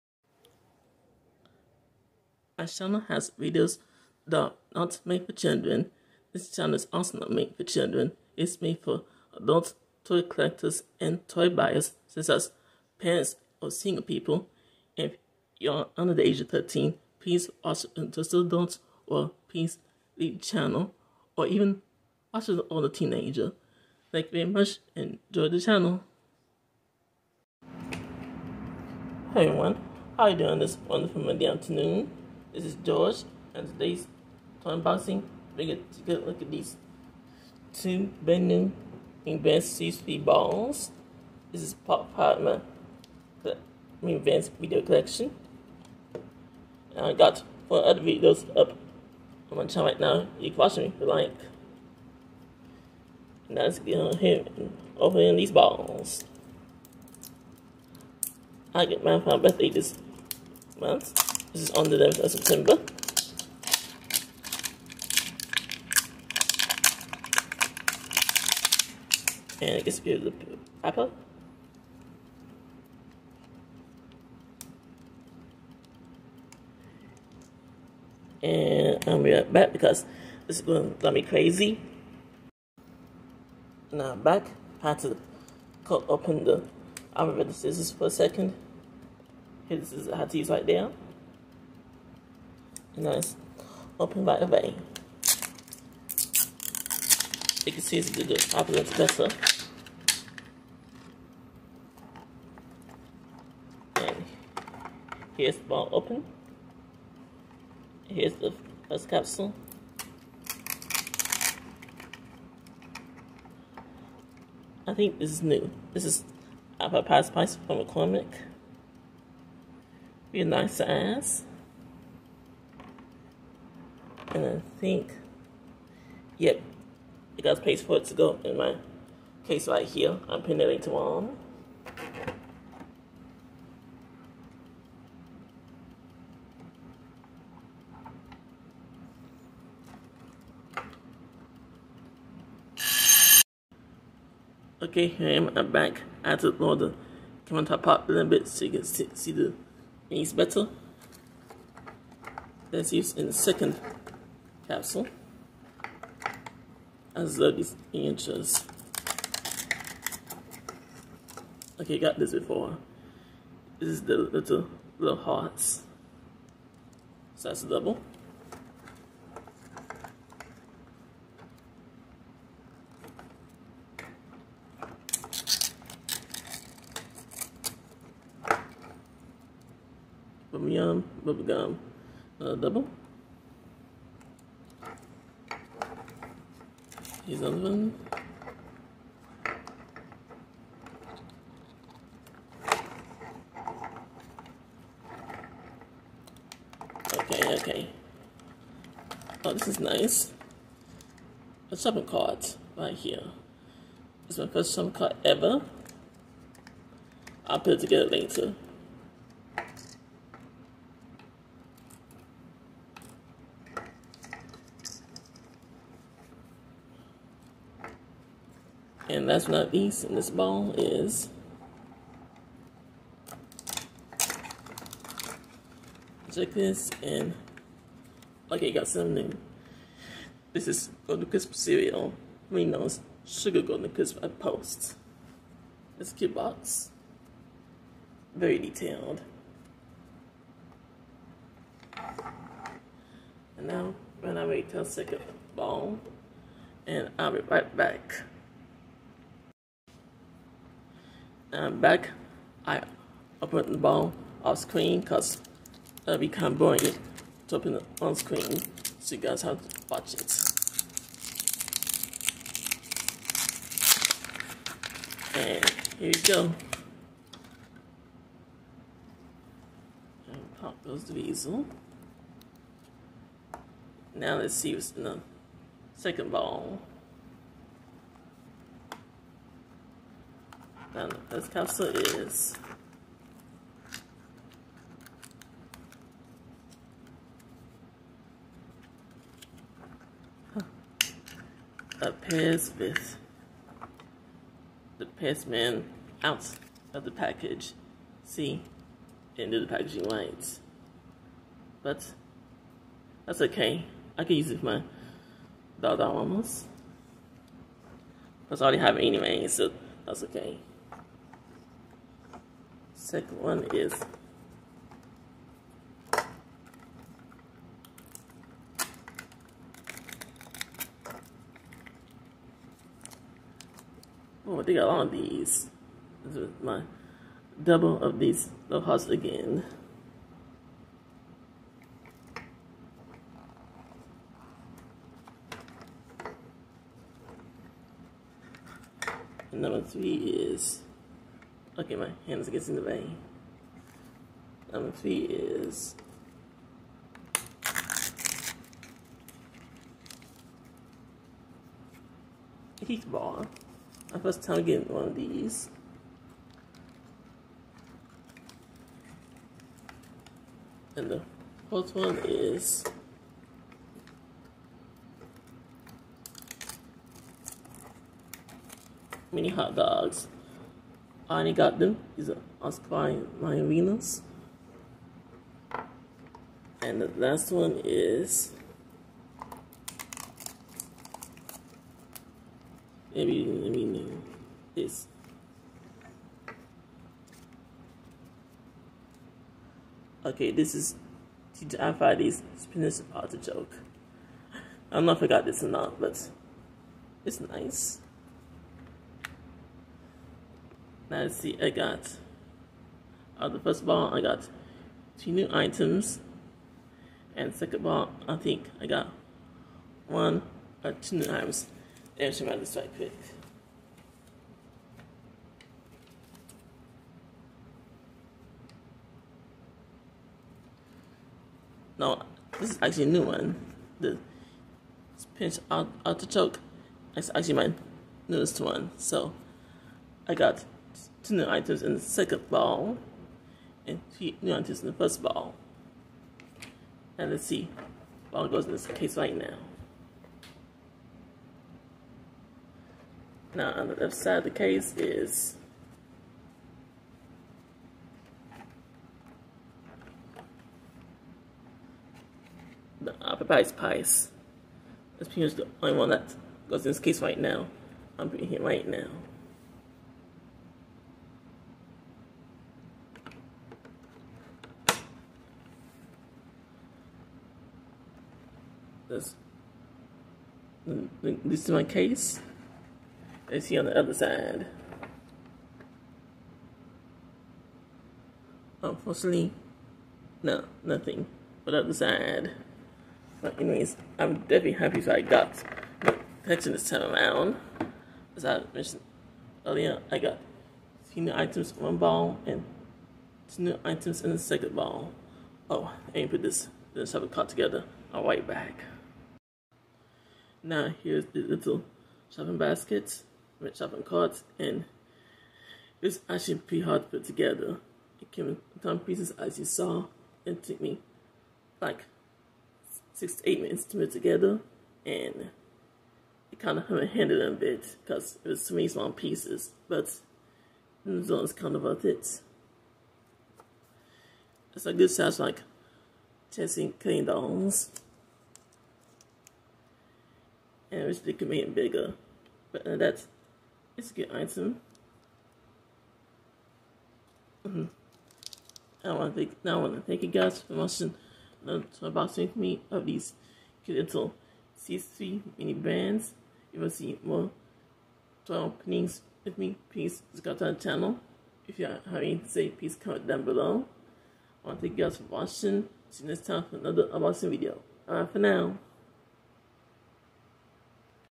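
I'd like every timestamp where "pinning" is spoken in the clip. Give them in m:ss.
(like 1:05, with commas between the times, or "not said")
2:10.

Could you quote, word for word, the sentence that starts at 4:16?
not it to open it on screen so you guys have to watch it.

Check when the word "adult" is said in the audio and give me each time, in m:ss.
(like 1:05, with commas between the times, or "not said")
0:09, 0:18.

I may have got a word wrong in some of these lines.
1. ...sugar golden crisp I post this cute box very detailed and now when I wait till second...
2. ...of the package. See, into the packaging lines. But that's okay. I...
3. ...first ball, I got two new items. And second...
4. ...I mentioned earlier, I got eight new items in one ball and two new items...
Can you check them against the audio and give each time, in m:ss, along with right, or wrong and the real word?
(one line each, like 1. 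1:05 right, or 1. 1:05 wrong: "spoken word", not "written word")
1. 3:53 right
2. 4:56 right
3. 6:43 right
4. 8:08 wrong: "two", not "eight".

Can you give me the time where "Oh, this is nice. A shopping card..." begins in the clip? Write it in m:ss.
3:19.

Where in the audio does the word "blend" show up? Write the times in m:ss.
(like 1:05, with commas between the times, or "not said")
not said.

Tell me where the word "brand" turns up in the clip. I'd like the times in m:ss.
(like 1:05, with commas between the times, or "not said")
0:38, 9:05.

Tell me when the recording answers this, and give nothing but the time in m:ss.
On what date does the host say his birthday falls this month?
1:01.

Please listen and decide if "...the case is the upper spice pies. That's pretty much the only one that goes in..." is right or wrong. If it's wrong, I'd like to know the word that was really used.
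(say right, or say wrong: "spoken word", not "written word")
wrong: "price", not "spice".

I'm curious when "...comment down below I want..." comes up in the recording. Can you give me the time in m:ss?
9:13.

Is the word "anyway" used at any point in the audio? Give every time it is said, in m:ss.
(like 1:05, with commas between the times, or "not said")
5:08, 8:03.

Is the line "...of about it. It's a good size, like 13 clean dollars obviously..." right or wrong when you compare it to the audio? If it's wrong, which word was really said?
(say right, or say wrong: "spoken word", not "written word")
wrong: "10", not "13".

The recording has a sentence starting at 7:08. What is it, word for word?
So I got two new items in the second ball and two new items in the first ball.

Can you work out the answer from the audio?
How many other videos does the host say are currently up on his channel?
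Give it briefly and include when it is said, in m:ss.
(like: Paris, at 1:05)
4, at 0:47.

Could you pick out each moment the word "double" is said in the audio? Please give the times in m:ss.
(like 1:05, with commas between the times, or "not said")
2:47, 3:02, 5:27.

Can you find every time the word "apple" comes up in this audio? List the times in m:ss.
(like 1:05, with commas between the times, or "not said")
1:10, 1:56.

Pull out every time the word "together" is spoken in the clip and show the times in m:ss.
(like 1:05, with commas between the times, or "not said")
3:27, 8:17, 8:27, 8:34.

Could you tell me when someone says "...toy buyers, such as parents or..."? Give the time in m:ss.
0:11.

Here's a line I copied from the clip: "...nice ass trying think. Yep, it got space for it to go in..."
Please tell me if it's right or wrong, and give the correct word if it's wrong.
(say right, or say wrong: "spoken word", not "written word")
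right.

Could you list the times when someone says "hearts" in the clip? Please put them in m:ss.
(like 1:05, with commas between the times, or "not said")
2:45, 5:28.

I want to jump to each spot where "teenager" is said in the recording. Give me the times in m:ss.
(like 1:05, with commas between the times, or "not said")
0:22.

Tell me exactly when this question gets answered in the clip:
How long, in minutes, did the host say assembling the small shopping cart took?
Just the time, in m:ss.
8:33.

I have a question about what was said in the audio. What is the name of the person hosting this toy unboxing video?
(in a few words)
George.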